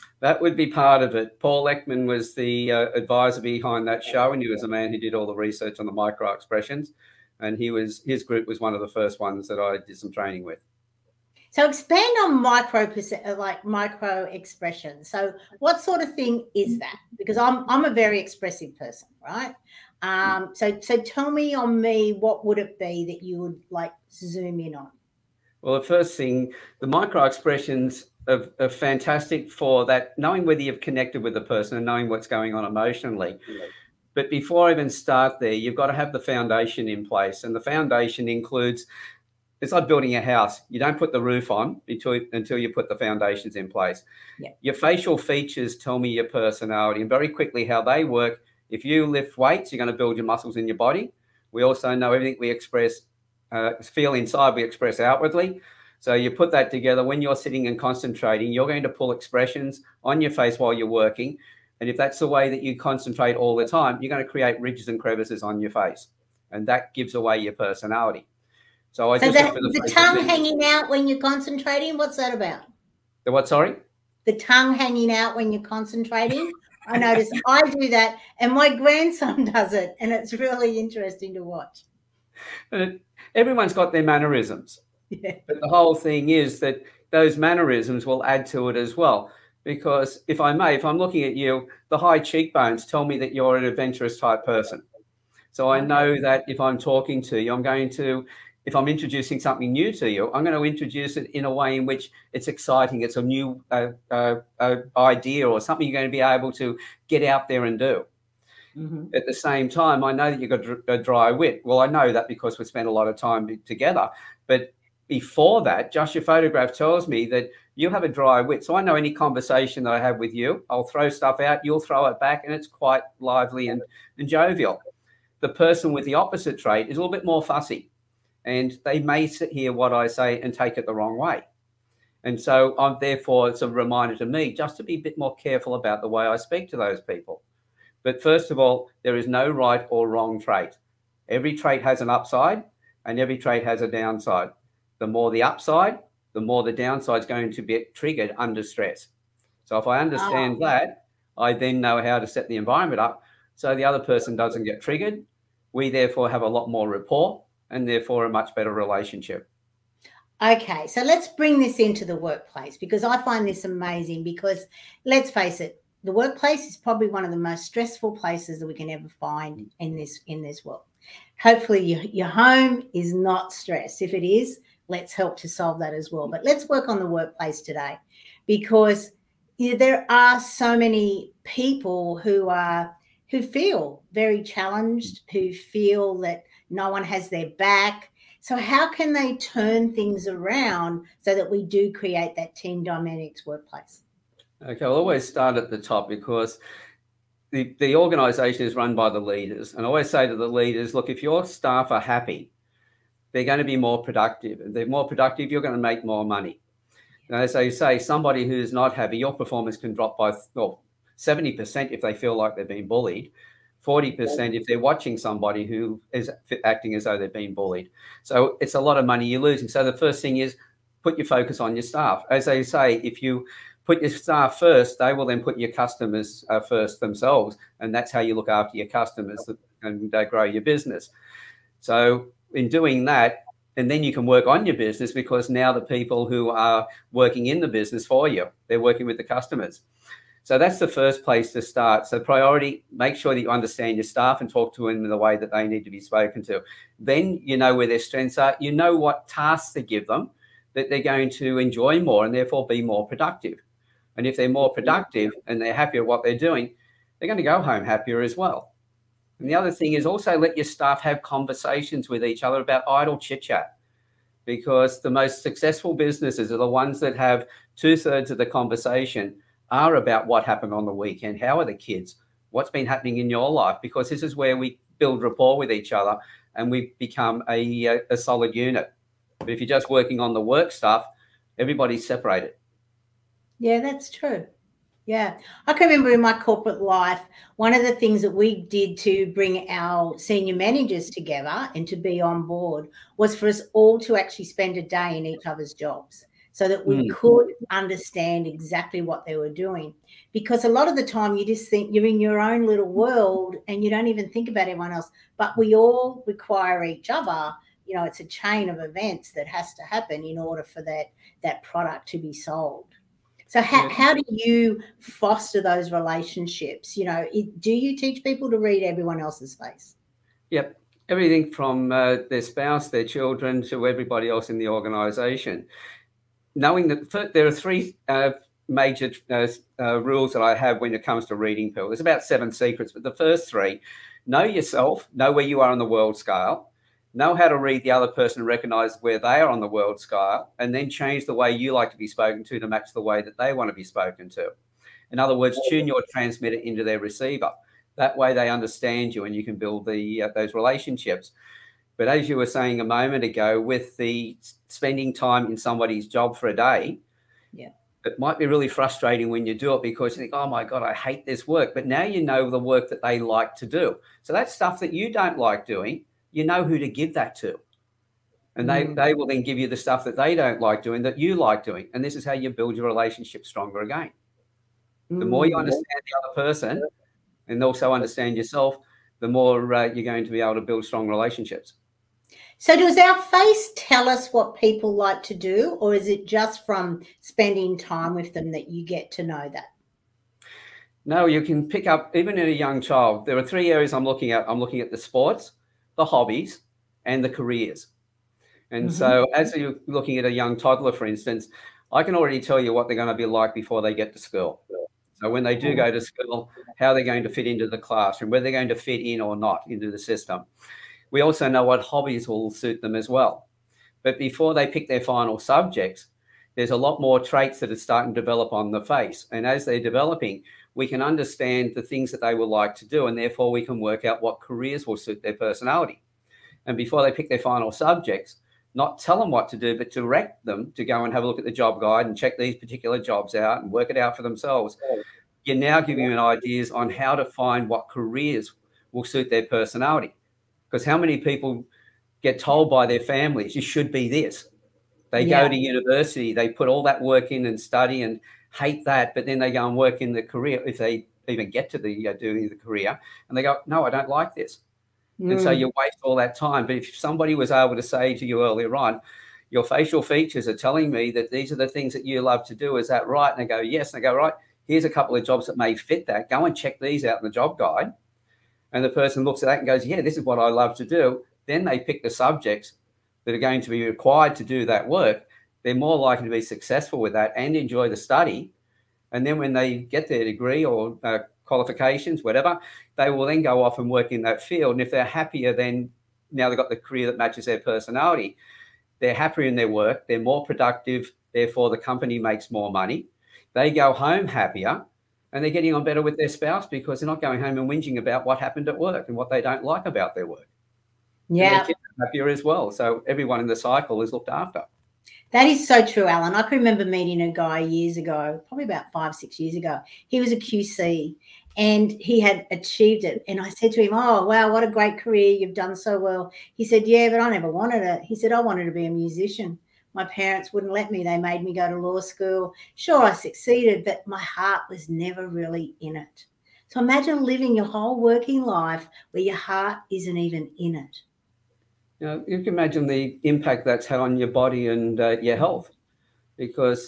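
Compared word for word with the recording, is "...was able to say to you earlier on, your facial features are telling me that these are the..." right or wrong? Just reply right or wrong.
right.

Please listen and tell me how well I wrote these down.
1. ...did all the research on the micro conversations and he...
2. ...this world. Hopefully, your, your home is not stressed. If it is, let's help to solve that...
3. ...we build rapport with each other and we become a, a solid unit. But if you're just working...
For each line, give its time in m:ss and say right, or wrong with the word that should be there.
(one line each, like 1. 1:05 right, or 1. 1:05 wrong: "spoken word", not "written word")
1. 0:04 wrong: "expressions", not "conversations"
2. 2:50 right
3. 4:34 right.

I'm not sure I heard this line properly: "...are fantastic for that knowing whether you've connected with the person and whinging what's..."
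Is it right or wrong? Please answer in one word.
wrong.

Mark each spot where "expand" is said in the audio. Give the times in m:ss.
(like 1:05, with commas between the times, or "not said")
0:11.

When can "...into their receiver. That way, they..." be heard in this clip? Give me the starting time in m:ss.
5:46.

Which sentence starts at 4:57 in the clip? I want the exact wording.
could understand exactly what they were doing.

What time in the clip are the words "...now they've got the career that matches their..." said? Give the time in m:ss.
8:06.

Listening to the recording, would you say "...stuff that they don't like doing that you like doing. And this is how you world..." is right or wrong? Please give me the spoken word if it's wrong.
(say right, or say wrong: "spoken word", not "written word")
wrong: "build", not "world".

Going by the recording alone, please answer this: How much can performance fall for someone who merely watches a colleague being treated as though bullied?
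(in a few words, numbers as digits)
40%.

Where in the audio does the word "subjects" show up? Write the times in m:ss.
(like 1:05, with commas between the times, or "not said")
6:55, 7:07, 7:52.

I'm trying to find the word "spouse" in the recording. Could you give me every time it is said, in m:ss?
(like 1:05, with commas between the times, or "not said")
5:22, 8:16.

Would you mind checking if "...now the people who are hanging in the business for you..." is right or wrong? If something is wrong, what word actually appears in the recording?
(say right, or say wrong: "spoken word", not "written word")
wrong: "working", not "hanging".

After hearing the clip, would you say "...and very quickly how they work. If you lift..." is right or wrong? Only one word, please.
right.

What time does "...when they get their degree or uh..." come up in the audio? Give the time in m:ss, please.
7:59.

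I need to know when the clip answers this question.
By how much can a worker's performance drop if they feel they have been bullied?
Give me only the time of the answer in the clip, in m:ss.
3:31.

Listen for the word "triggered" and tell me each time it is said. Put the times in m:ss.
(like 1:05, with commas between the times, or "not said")
2:27, 2:34.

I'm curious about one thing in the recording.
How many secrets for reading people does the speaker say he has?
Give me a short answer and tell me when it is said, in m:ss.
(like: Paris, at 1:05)
Seven, at 5:32.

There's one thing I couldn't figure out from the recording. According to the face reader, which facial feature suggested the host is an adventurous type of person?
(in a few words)
High cheekbones.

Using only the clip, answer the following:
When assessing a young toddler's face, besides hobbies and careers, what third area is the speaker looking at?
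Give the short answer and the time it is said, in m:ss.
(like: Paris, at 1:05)
Sports, at 6:34.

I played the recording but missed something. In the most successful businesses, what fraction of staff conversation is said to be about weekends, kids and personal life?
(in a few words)
Two thirds.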